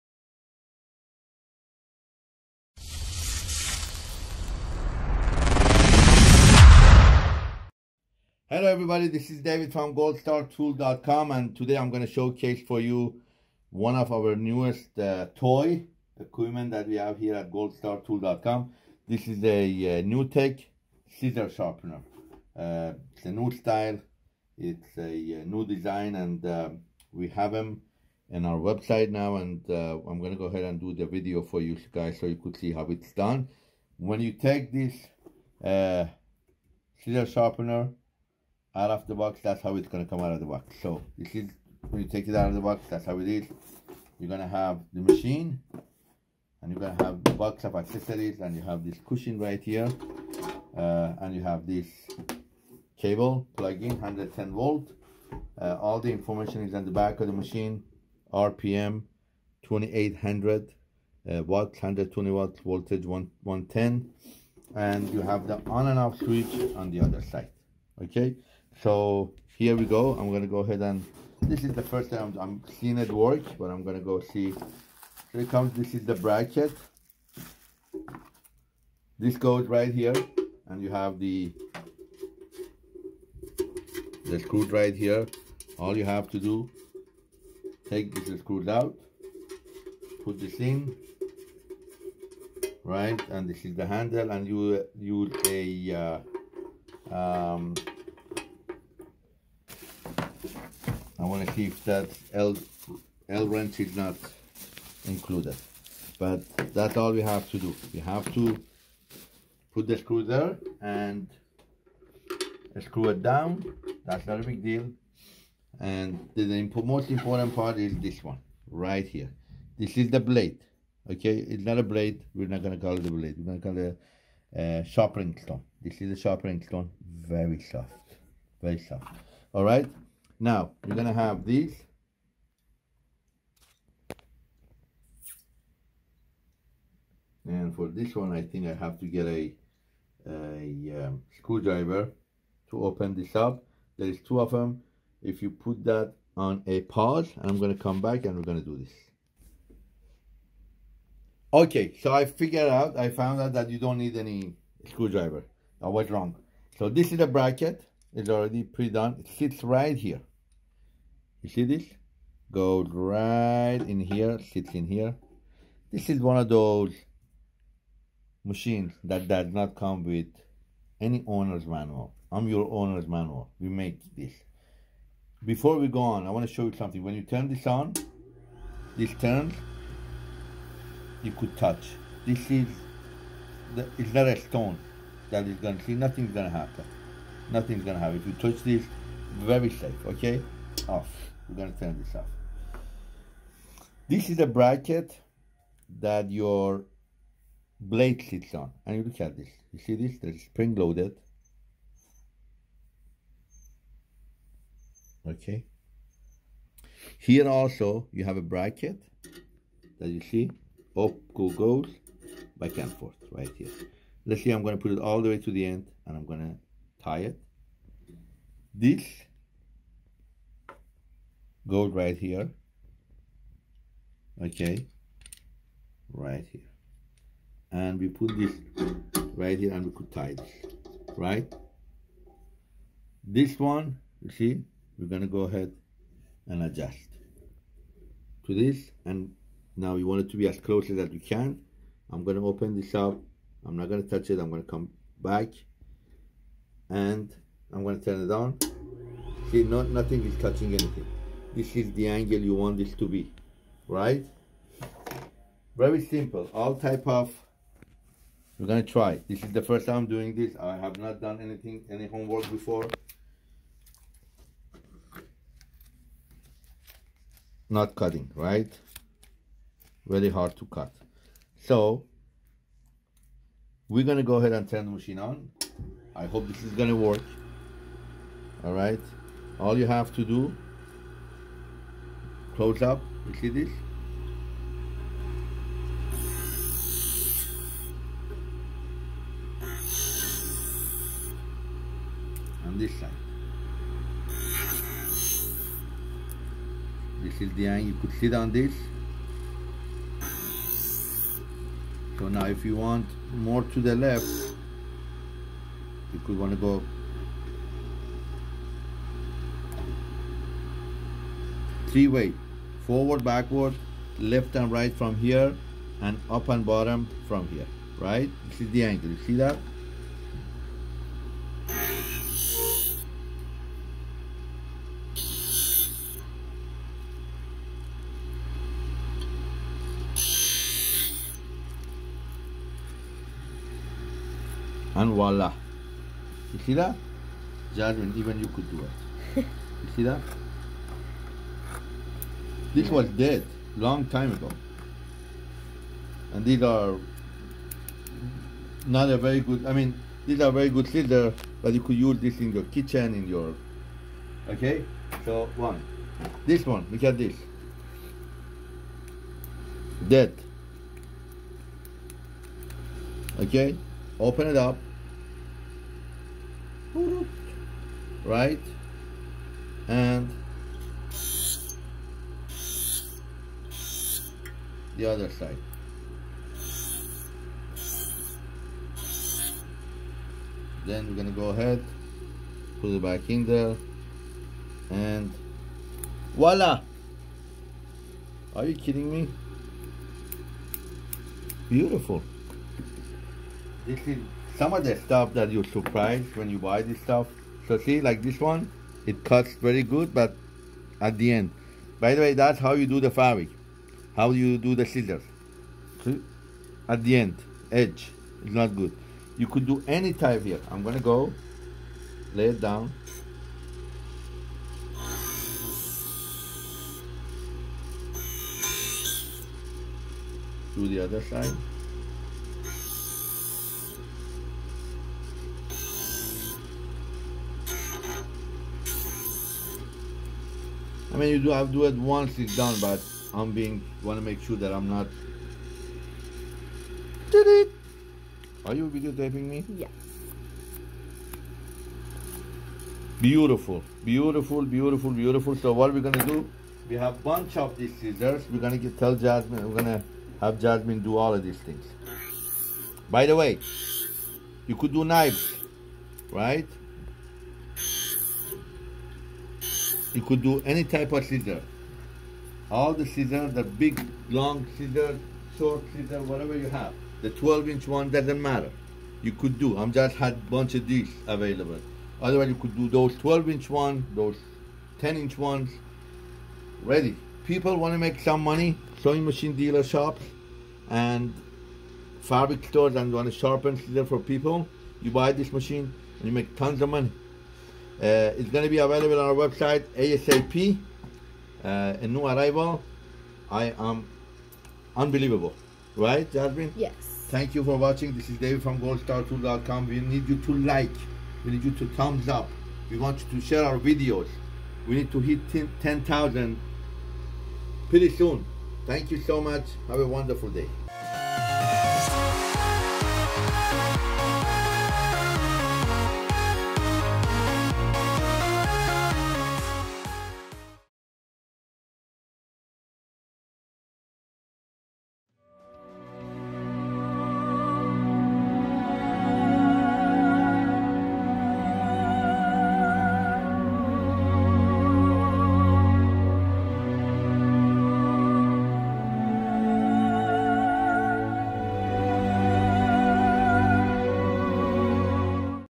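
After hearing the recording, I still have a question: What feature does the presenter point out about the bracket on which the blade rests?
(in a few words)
spring loaded.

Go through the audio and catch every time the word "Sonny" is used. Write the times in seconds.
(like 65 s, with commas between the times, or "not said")
not said.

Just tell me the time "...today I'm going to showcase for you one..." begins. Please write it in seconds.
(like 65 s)
11 s.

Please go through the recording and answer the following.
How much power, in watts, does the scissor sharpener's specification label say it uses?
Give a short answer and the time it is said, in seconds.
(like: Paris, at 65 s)
120 watts, at 61 s.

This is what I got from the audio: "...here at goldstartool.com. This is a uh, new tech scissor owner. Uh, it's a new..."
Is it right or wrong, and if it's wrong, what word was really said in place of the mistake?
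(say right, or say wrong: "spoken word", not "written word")
wrong: "sharpener", not "owner".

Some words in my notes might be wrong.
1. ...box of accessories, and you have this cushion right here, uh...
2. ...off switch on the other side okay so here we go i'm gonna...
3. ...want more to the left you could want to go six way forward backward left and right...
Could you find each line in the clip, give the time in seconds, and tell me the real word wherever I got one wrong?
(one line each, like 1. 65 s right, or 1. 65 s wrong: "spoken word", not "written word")
1. 47 s right
2. 65 s right
3. 302 s wrong: "three", not "six".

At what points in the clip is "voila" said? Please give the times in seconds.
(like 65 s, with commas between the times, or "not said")
335 s, 386 s.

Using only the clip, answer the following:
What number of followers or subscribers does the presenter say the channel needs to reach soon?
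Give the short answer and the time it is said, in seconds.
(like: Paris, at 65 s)
10,000, at 505 s.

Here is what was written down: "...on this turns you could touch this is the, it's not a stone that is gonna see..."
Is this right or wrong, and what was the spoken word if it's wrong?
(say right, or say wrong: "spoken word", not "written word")
right.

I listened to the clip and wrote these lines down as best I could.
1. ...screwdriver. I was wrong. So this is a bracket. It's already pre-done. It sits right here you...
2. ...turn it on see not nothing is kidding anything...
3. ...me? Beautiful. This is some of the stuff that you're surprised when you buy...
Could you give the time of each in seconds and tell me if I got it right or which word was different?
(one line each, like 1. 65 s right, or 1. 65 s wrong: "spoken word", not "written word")
1. 154 s right
2. 247 s wrong: "touching", not "kidding"
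3. 389 s right.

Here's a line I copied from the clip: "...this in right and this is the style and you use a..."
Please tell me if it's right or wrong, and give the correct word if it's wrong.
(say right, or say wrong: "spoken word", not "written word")
wrong: "handle", not "style".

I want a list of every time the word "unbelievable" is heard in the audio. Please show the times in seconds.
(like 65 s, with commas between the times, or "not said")
494 s.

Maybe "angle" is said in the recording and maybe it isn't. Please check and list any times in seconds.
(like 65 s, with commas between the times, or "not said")
252 s, 297 s, 318 s.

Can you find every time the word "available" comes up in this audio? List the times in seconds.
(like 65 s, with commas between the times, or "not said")
471 s, 488 s.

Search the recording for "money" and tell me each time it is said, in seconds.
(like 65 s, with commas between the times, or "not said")
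478 s, 486 s.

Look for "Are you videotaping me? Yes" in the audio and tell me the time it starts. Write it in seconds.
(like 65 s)
438 s.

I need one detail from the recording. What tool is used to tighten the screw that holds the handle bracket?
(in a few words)
L wrench.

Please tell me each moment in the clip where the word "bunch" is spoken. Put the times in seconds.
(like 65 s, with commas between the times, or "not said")
447 s, 470 s.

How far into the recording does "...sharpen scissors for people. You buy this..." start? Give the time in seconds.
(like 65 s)
483 s.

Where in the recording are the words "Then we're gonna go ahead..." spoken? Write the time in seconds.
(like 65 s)
380 s.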